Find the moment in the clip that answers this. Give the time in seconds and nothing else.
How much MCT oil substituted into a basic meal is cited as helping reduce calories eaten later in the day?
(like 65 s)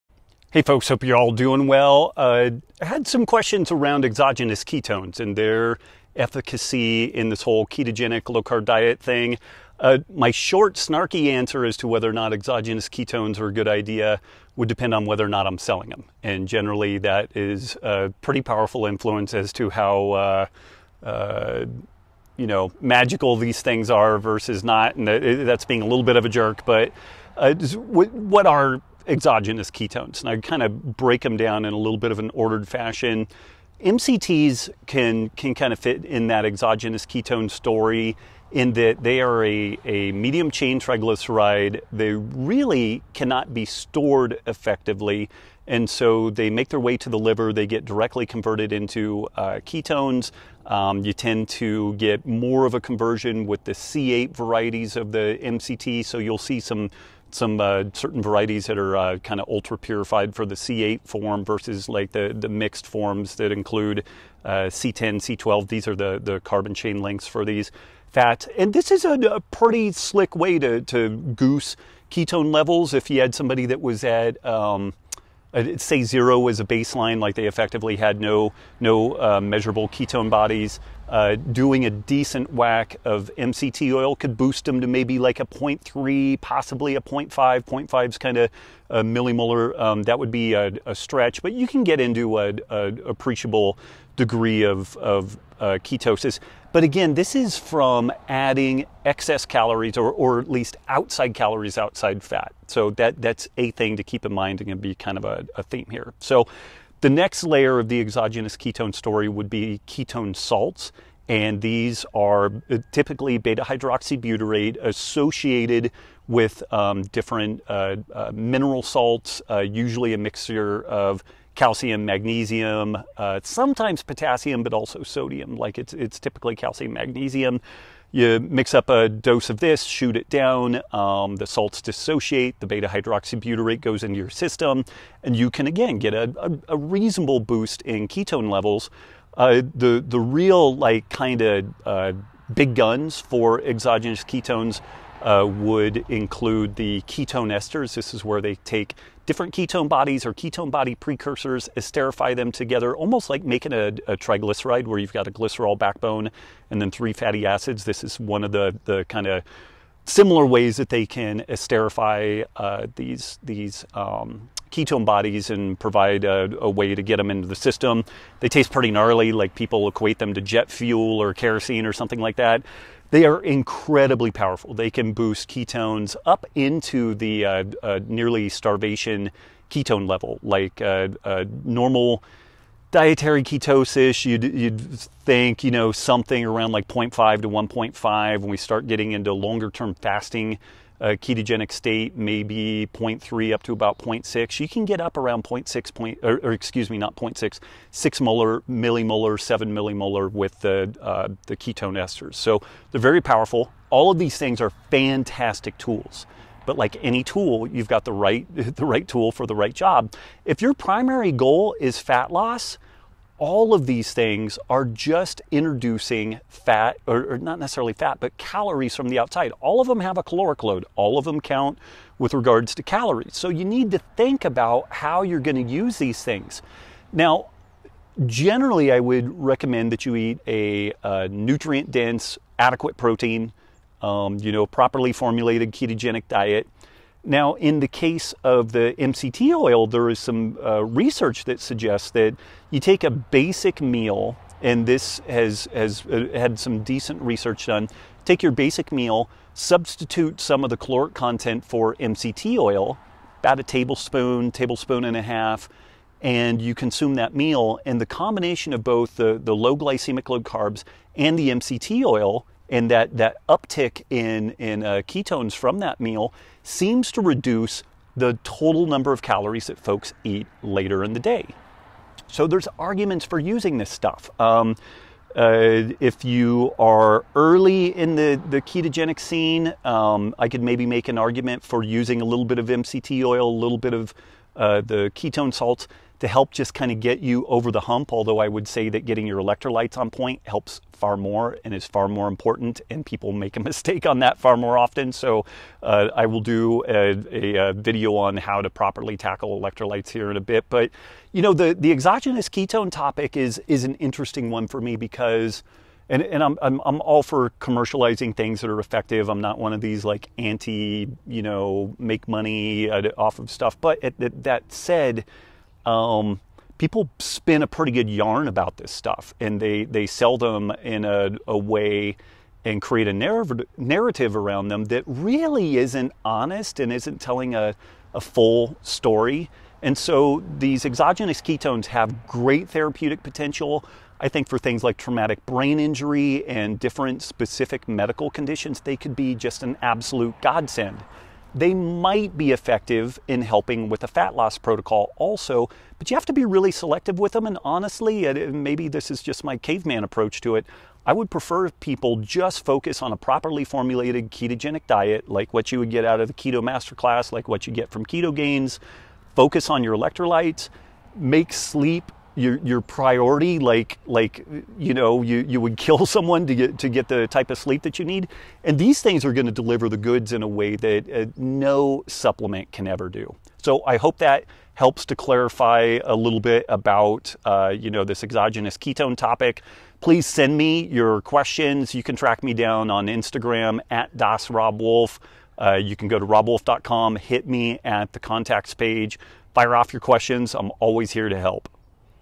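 253 s.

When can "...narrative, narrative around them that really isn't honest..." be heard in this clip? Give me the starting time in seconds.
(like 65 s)
323 s.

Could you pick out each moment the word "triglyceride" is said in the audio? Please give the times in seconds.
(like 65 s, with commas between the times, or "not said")
40 s, 154 s.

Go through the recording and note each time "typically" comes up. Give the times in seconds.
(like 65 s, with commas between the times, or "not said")
112 s, 126 s.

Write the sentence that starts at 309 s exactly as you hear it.
I'm not one of these like anti, you know, make money uh, off of stuff.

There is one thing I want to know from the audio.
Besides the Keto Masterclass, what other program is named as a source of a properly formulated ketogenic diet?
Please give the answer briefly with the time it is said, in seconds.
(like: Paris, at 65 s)
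Keto Gains, at 358 s.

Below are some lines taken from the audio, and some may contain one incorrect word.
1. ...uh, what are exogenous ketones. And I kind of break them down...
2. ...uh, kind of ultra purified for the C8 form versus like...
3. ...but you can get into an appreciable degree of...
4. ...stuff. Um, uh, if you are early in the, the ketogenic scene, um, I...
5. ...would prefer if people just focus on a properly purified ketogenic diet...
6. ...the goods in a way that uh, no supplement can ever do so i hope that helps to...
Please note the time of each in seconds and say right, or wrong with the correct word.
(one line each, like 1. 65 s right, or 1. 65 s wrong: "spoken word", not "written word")
1. 27 s right
2. 58 s right
3. 91 s right
4. 273 s right
5. 351 s wrong: "formulated", not "purified"
6. 369 s right.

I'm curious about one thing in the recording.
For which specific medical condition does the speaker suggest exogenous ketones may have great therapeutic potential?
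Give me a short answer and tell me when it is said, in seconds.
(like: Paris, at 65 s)
traumatic brain injury, at 334 s.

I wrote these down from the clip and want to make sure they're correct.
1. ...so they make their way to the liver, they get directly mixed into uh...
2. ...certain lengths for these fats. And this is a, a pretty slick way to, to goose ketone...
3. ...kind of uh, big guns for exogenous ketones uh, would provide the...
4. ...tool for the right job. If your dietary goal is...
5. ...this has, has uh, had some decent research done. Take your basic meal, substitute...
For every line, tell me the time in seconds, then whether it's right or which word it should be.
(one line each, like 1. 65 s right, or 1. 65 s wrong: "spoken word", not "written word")
1. 45 s wrong: "converted", not "mixed"
2. 66 s wrong: "chain", not "certain"
3. 141 s wrong: "include", not "provide"
4. 209 s wrong: "primary", not "dietary"
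5. 244 s right.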